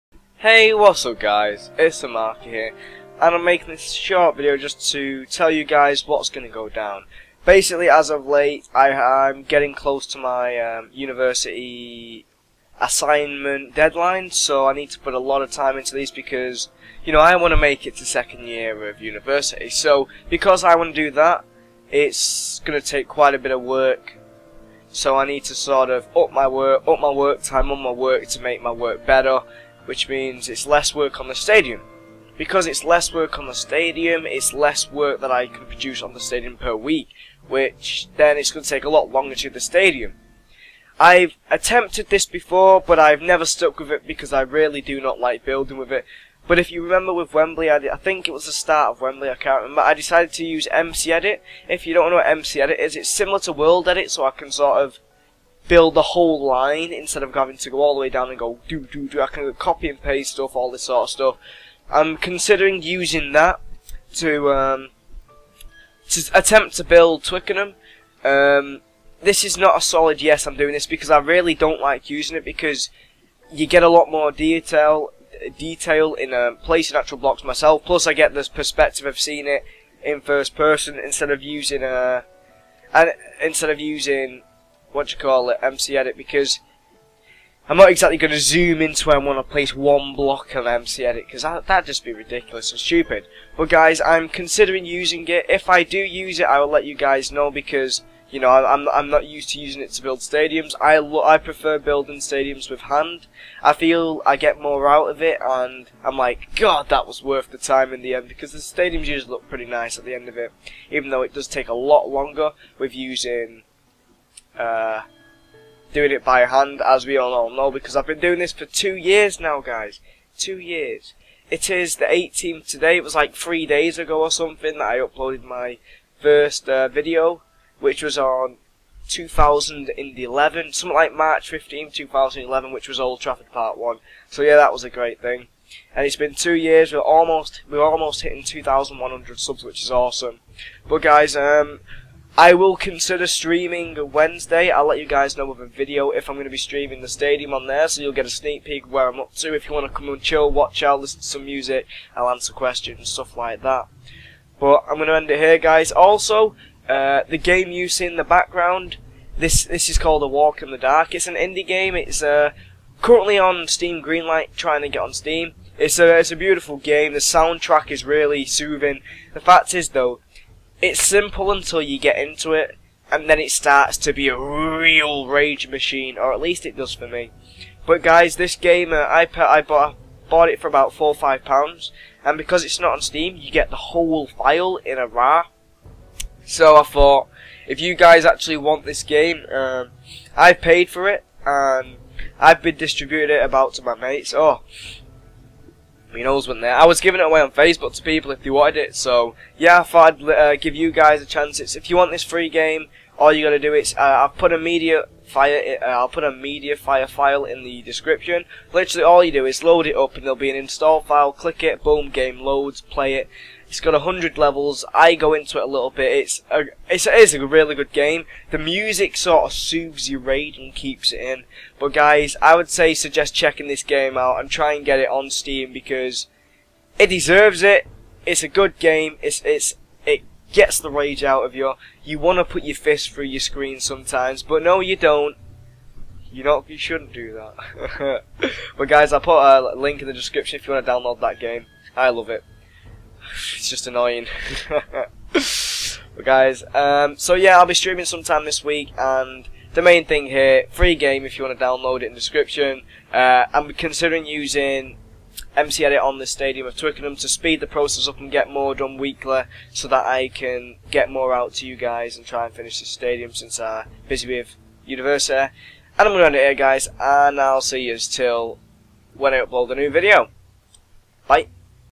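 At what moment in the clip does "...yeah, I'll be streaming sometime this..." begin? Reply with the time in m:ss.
4:07.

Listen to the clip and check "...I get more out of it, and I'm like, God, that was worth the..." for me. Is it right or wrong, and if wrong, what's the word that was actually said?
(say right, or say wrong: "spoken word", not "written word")
right.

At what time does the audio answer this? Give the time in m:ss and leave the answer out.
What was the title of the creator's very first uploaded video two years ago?
2:12.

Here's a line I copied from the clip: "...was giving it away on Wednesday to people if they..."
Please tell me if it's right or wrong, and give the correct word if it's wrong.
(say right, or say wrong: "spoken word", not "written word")
wrong: "Facebook", not "Wednesday".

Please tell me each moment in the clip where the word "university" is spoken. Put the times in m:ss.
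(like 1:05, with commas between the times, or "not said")
0:10, 0:18, 4:24.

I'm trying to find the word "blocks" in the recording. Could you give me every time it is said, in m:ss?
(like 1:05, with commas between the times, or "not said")
1:17, 1:30.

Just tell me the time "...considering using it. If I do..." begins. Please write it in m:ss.
1:34.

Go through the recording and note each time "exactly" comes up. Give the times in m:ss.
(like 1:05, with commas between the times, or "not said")
1:27.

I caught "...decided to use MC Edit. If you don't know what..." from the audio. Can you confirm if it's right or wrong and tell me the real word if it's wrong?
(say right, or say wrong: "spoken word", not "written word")
right.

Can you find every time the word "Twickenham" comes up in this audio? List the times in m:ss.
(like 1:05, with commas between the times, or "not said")
1:07, 4:16.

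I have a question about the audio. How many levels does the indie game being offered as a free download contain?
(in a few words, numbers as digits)
100.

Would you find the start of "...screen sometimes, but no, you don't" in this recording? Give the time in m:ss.
3:53.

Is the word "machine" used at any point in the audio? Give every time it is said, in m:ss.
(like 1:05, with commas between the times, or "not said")
2:55.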